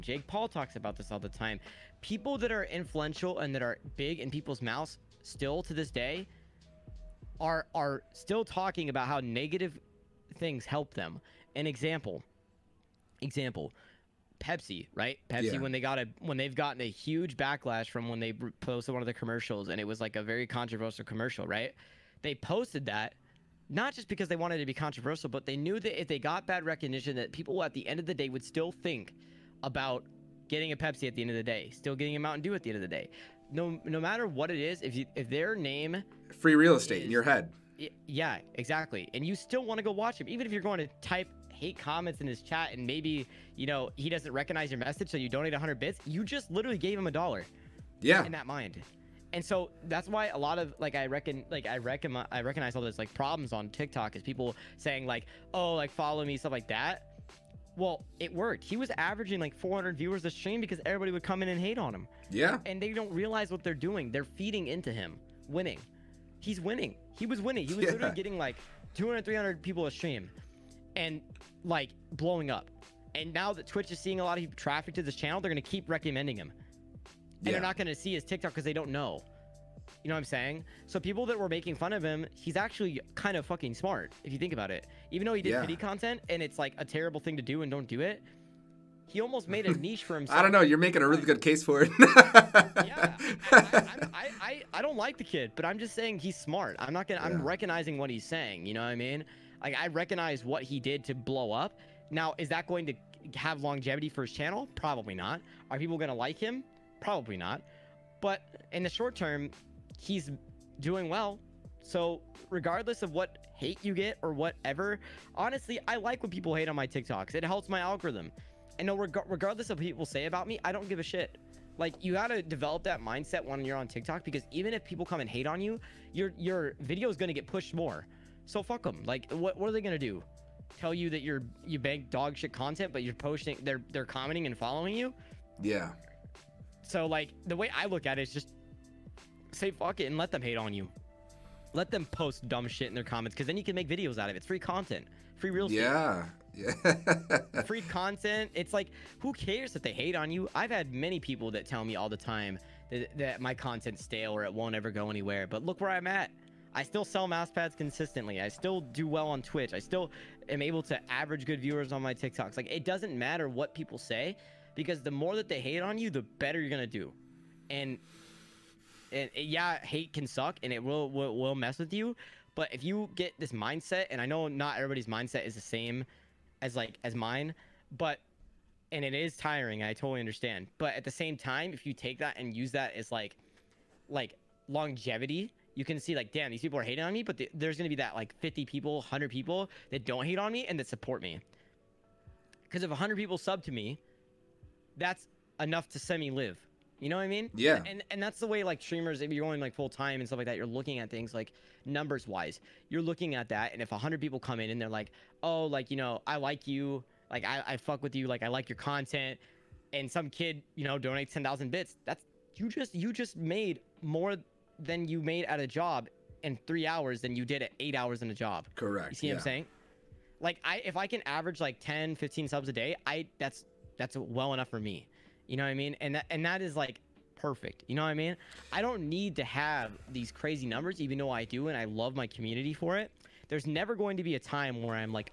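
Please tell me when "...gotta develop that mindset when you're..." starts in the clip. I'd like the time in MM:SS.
02:02.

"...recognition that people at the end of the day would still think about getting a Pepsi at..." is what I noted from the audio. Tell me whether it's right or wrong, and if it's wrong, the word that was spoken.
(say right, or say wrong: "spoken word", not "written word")
right.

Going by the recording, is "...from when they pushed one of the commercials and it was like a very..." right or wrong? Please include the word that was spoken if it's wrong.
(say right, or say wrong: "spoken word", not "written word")
wrong: "posted", not "pushed".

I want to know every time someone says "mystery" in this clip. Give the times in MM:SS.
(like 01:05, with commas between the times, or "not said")
not said.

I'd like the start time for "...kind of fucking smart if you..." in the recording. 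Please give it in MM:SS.
01:23.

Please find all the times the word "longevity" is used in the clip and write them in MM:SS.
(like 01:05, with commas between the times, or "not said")
01:43, 03:04.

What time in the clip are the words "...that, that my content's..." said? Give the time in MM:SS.
02:32.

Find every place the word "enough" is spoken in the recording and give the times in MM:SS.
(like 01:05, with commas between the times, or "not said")
03:15, 03:44.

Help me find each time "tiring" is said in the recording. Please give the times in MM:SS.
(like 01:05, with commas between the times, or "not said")
02:59.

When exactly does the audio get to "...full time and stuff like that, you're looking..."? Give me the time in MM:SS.
03:19.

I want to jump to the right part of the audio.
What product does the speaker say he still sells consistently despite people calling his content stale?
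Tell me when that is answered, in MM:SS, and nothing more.
02:37.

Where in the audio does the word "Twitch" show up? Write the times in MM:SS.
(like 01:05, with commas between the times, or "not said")
01:13, 02:39.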